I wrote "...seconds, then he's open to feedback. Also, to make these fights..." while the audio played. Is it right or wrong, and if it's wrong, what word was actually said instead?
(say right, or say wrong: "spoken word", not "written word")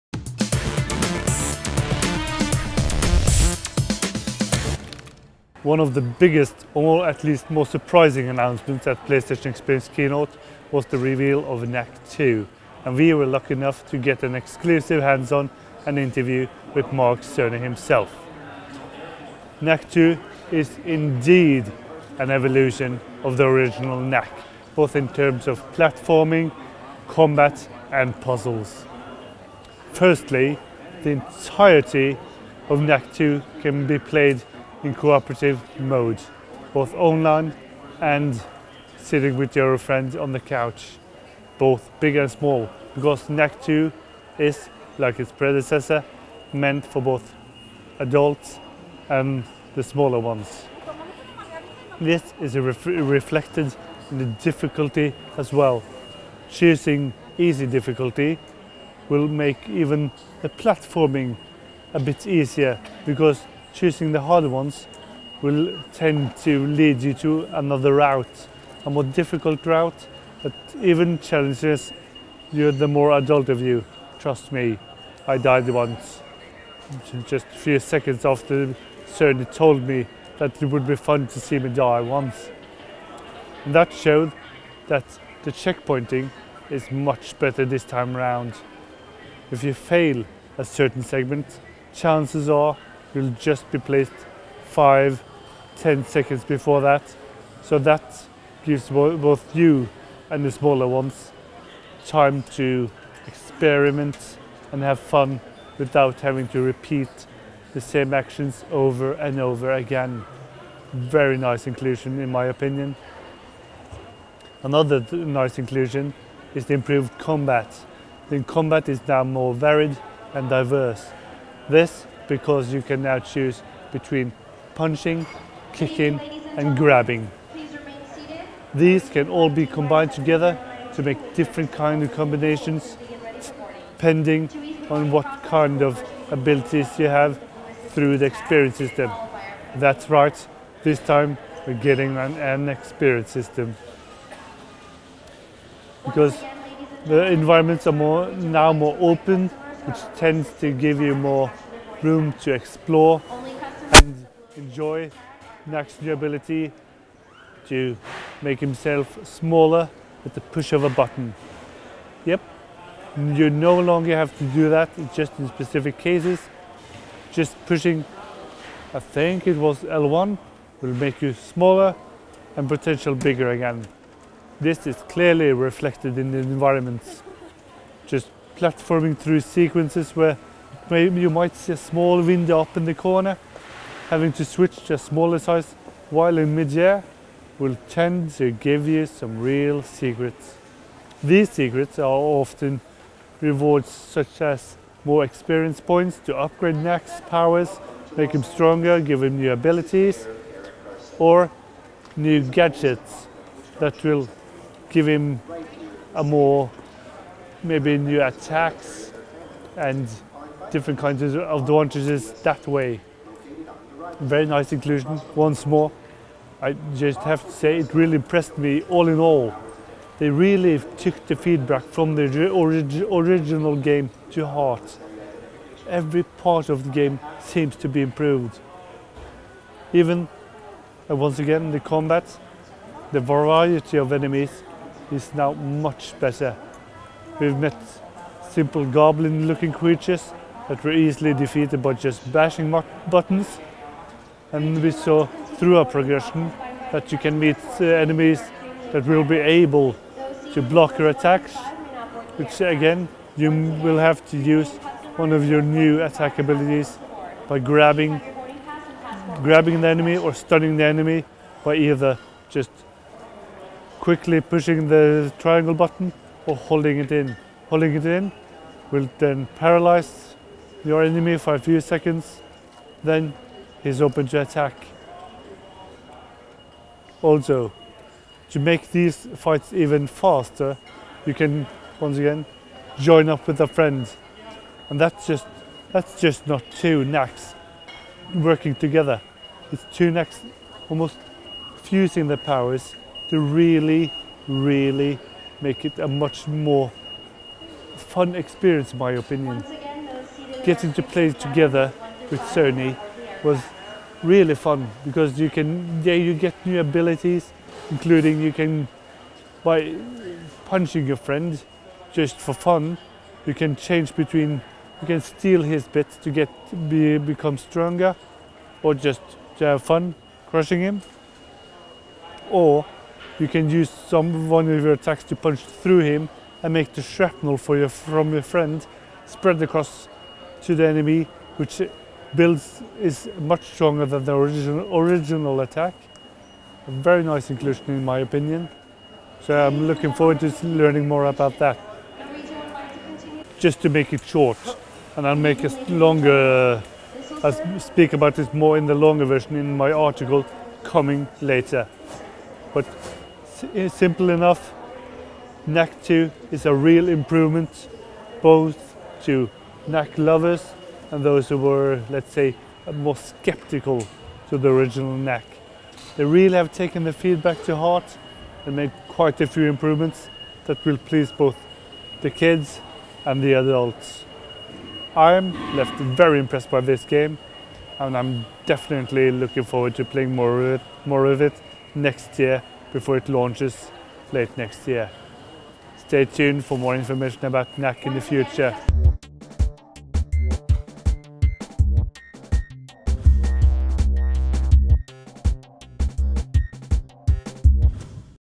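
wrong: "attack", not "feedback".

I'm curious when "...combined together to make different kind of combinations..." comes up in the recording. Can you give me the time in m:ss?
2:09.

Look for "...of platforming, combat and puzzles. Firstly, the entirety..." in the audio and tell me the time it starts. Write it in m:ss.
0:25.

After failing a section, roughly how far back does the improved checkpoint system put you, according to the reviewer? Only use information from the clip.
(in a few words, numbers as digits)
5, 10 seconds.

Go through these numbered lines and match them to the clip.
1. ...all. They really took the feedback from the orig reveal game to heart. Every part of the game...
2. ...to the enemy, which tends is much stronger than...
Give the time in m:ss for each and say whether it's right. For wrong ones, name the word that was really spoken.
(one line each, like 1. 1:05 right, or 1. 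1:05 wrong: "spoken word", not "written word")
1. 3:39 wrong: "original", not "reveal"
2. 5:30 wrong: "builds", not "tends".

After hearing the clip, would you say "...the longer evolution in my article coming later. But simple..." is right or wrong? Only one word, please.
wrong.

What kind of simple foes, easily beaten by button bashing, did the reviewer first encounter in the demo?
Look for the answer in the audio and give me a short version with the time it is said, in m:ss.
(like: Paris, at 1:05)
goblin looking creatures, at 3:58.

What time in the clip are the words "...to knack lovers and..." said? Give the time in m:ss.
5:59.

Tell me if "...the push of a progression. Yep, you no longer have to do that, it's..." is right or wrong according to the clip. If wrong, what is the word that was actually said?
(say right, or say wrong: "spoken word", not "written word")
wrong: "button", not "progression".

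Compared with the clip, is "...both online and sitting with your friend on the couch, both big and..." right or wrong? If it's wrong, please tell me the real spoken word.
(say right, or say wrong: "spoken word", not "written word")
right.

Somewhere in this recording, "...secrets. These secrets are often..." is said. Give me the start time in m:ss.
3:09.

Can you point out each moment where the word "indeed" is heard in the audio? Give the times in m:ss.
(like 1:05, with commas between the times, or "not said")
0:20.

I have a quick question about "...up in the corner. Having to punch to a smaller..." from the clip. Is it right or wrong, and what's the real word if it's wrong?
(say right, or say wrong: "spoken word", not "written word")
wrong: "switch", not "punch".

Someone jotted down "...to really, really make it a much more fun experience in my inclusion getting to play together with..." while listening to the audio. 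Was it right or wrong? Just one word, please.
wrong.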